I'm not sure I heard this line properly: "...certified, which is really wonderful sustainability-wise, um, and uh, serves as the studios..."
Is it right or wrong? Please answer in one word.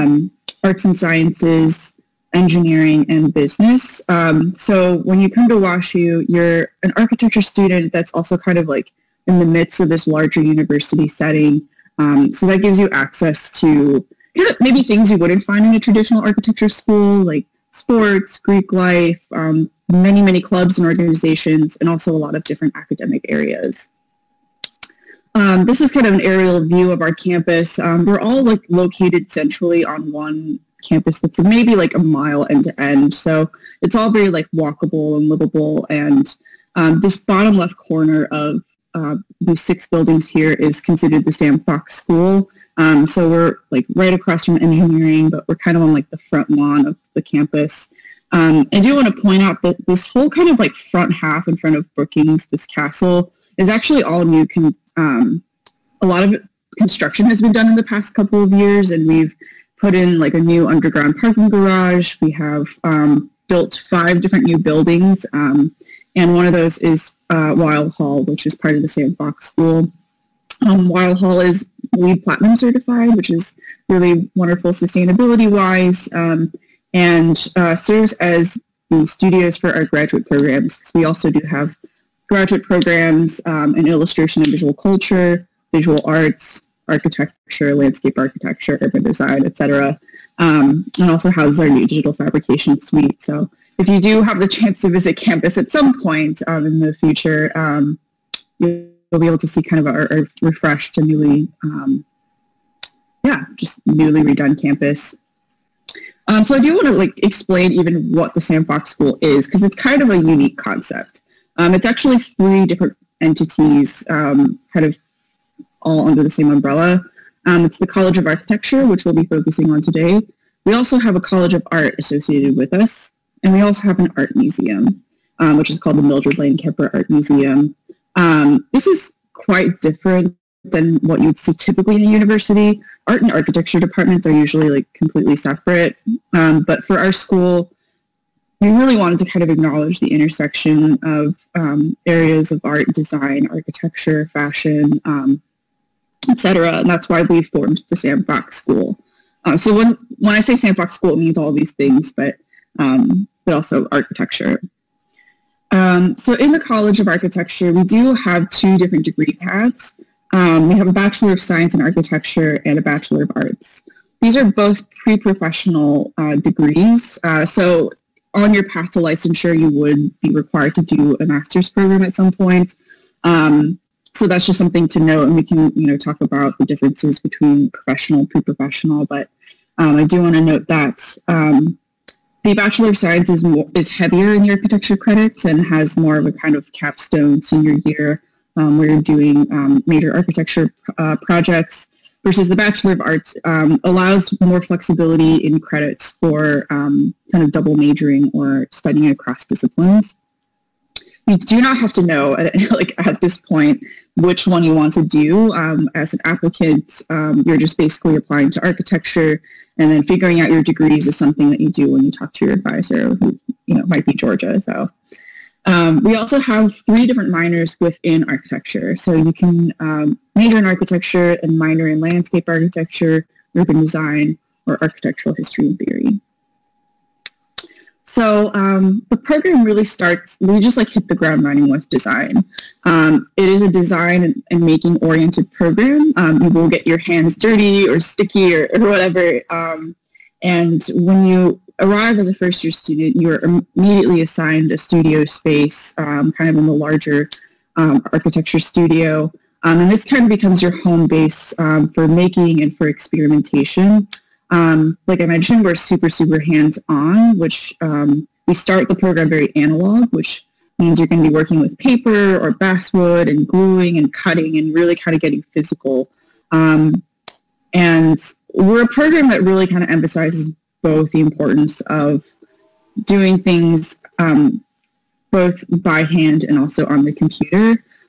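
right.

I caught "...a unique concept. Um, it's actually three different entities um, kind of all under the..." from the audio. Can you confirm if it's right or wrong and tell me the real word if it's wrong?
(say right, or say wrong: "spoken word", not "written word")
right.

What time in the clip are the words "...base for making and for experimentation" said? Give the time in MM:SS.
04:11.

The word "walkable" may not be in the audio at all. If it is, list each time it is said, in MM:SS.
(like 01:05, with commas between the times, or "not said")
00:34.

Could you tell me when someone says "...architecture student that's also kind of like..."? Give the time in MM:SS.
00:06.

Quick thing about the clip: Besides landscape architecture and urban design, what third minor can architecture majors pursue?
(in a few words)
Architectural history and theory.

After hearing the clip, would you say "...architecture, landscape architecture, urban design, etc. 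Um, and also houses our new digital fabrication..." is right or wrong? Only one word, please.
right.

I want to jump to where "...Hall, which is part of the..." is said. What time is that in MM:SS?
01:07.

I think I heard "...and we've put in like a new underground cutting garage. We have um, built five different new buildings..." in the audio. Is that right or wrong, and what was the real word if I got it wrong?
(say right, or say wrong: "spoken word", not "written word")
wrong: "parking", not "cutting".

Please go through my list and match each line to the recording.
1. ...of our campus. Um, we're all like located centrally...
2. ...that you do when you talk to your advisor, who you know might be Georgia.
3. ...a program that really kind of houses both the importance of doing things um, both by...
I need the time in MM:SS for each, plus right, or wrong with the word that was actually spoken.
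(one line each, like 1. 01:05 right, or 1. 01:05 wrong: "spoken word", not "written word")
1. 00:26 right
2. 03:31 right
3. 04:28 wrong: "emphasizes", not "houses".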